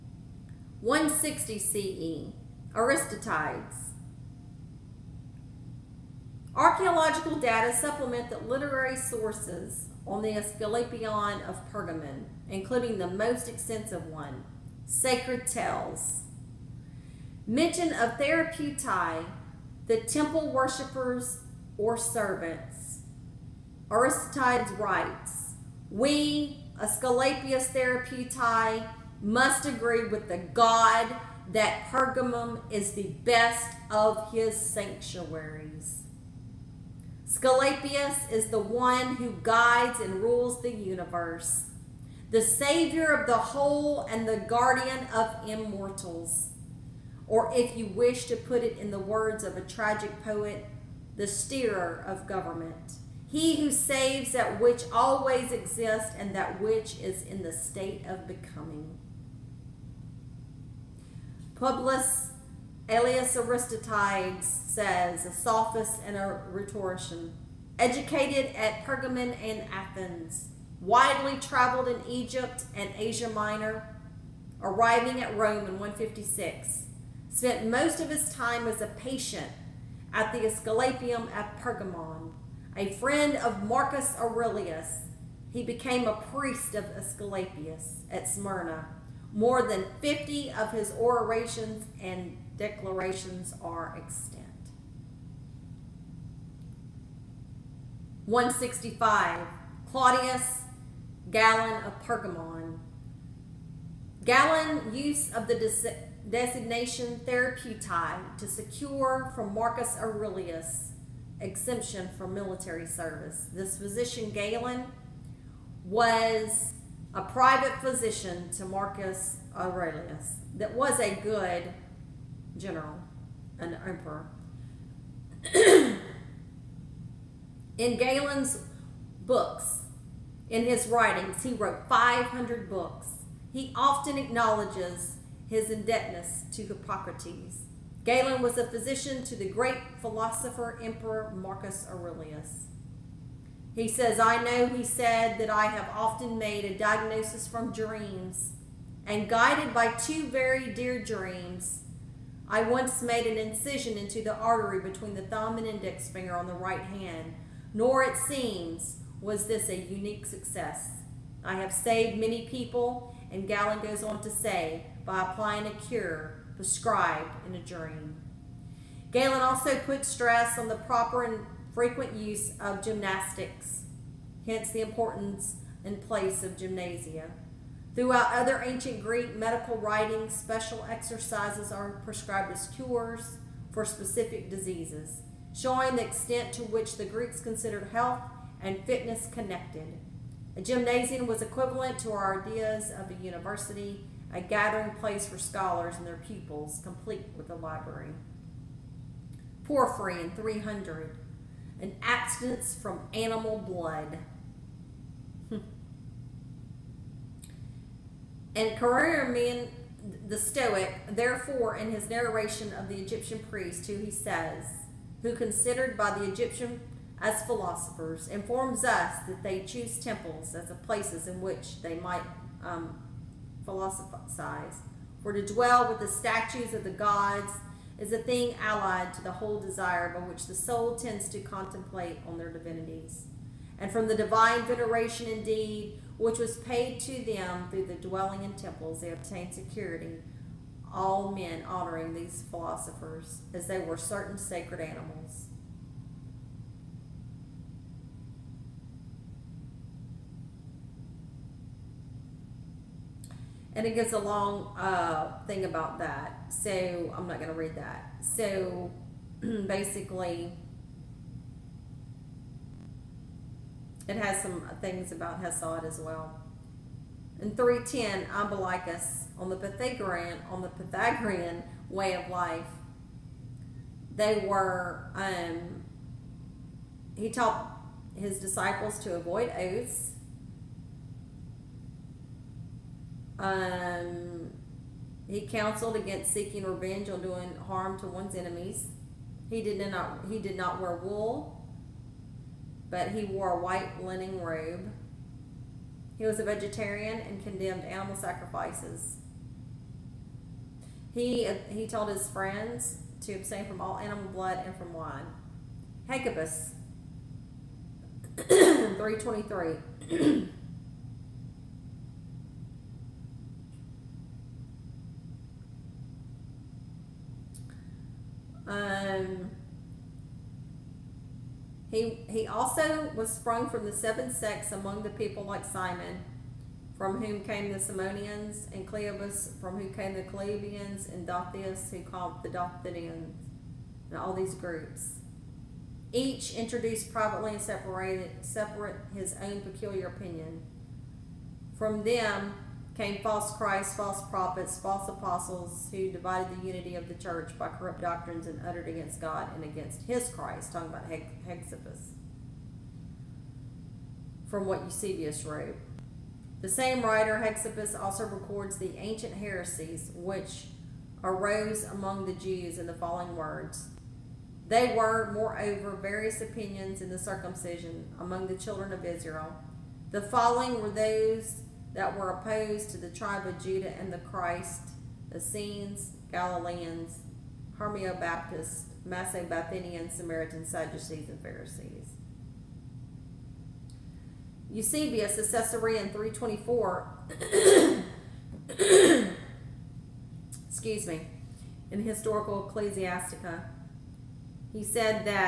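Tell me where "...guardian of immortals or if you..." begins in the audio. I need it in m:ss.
0:44.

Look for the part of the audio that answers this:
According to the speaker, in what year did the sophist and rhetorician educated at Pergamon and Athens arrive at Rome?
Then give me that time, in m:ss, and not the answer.
1:15.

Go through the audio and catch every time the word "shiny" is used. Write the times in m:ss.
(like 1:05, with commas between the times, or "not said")
not said.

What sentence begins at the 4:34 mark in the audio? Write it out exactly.
They were um, he taught his disciples to avoid oaths Um, he counseled against seeking revenge or doing harm to one's enemies.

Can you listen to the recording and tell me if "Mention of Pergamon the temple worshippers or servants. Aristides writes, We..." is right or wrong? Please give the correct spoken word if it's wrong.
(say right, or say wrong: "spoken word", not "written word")
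wrong: "Therapeutae", not "Pergamon".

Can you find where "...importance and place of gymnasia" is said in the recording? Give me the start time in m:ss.
2:54.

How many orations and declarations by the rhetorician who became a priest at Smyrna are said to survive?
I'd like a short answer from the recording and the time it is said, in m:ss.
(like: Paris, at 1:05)
More than 50, at 1:29.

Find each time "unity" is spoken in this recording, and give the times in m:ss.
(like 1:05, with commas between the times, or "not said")
5:46.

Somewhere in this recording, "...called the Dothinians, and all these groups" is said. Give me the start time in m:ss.
5:32.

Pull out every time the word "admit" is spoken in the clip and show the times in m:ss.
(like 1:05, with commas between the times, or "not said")
not said.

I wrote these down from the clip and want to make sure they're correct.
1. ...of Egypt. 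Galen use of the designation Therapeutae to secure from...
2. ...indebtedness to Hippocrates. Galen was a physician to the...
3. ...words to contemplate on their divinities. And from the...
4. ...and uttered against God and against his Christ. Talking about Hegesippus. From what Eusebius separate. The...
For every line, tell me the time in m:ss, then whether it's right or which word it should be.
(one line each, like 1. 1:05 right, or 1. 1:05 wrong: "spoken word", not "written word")
1. 1:41 wrong: "Pergamon", not "Egypt"
2. 2:15 right
3. 3:50 wrong: "tends", not "words"
4. 5:48 wrong: "wrote", not "separate".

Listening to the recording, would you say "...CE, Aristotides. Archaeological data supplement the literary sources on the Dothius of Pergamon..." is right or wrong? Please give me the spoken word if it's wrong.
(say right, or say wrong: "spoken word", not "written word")
wrong: "Asclepion", not "Dothius".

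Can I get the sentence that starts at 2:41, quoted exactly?
I have saved many people, and Galen goes on to say, by applying a cure prescribed in a dream.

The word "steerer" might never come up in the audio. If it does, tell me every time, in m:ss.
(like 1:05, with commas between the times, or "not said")
0:51.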